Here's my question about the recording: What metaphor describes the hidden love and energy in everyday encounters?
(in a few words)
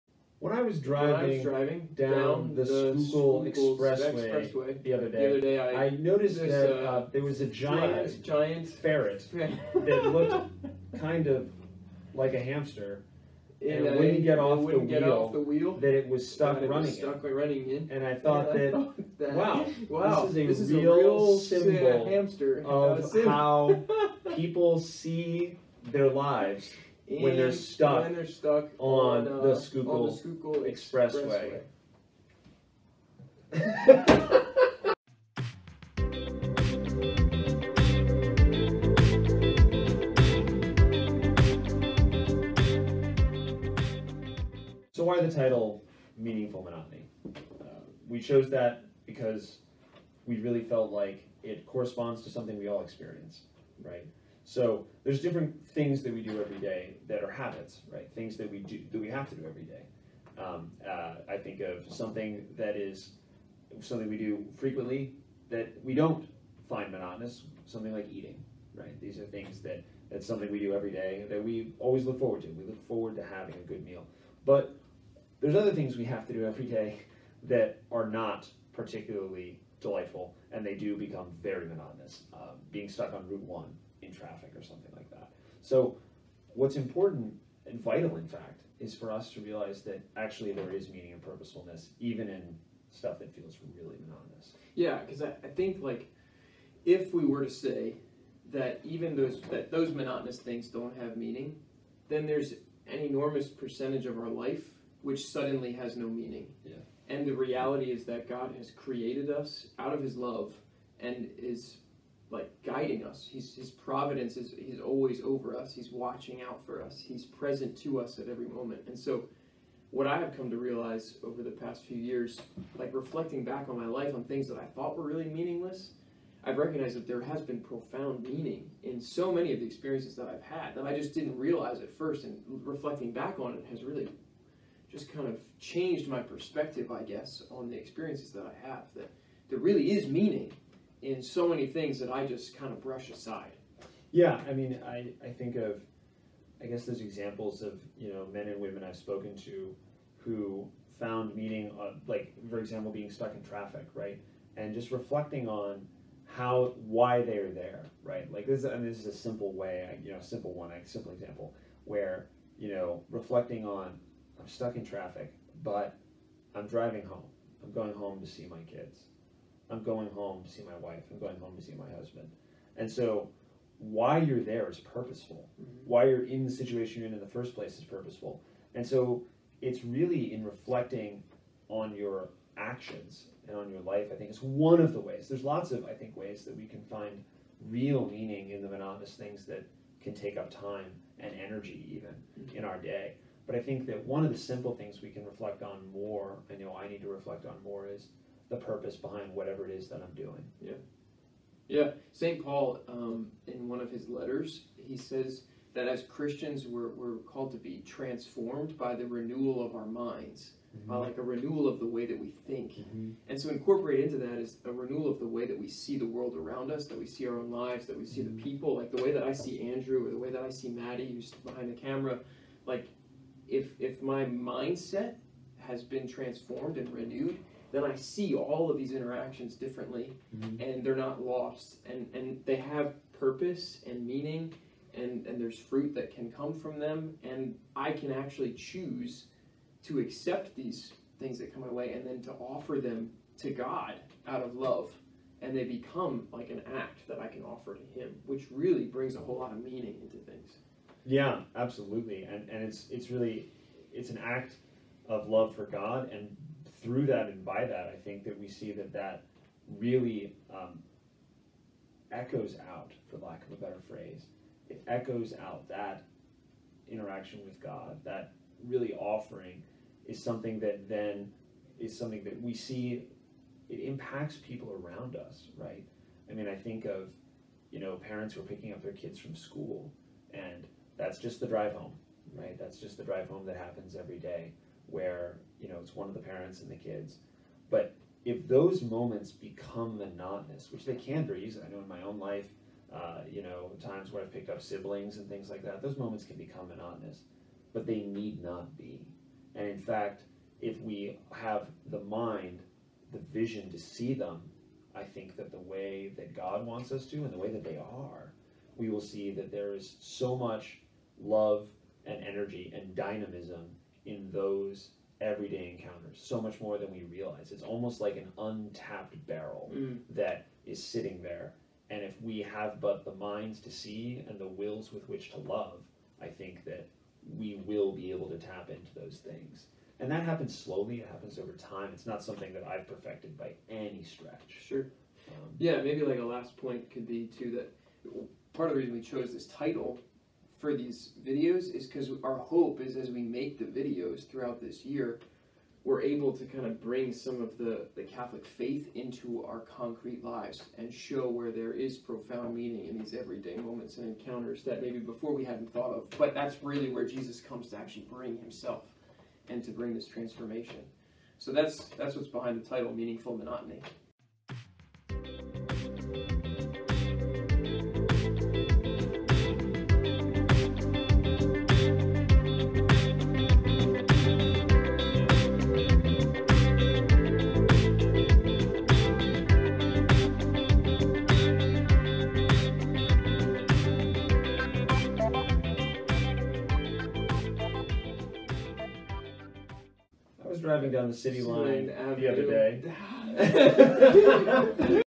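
untapped barrel.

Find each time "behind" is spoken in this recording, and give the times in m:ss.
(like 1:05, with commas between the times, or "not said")
3:18, 3:41, 6:02.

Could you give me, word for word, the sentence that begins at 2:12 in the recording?
And reflecting back on it has really just kind of changed my perspective, I guess, on the experiences that I have.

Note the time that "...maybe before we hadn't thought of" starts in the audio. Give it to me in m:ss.
5:54.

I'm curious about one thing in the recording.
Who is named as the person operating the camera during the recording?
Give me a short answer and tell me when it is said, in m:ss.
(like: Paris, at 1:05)
Maddie, at 3:40.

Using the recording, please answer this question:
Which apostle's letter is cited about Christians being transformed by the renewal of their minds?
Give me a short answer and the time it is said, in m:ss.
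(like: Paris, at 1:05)
St. Paul, at 3:22.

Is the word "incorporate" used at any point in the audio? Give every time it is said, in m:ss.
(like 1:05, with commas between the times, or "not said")
3:33.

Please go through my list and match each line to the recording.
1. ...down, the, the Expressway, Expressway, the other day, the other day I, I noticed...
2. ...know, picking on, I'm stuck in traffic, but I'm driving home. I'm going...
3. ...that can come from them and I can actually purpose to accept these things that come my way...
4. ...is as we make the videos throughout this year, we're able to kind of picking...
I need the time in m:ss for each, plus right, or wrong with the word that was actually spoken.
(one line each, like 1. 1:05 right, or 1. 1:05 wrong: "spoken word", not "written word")
1. 0:02 right
2. 2:42 wrong: "reflecting", not "picking"
3. 3:55 wrong: "choose", not "purpose"
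4. 5:42 wrong: "bring", not "picking".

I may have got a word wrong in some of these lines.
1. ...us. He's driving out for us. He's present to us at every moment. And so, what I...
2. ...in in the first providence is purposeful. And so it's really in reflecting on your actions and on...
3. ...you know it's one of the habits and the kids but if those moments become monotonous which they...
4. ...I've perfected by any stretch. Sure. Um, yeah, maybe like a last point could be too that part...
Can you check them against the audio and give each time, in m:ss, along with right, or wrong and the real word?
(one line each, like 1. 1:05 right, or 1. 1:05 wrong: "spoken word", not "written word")
1. 1:55 wrong: "watching", not "driving"
2. 2:57 wrong: "place", not "providence"
3. 4:45 wrong: "parents", not "habits"
4. 5:32 right.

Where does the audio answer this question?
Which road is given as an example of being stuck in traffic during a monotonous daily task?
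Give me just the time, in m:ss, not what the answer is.
1:23.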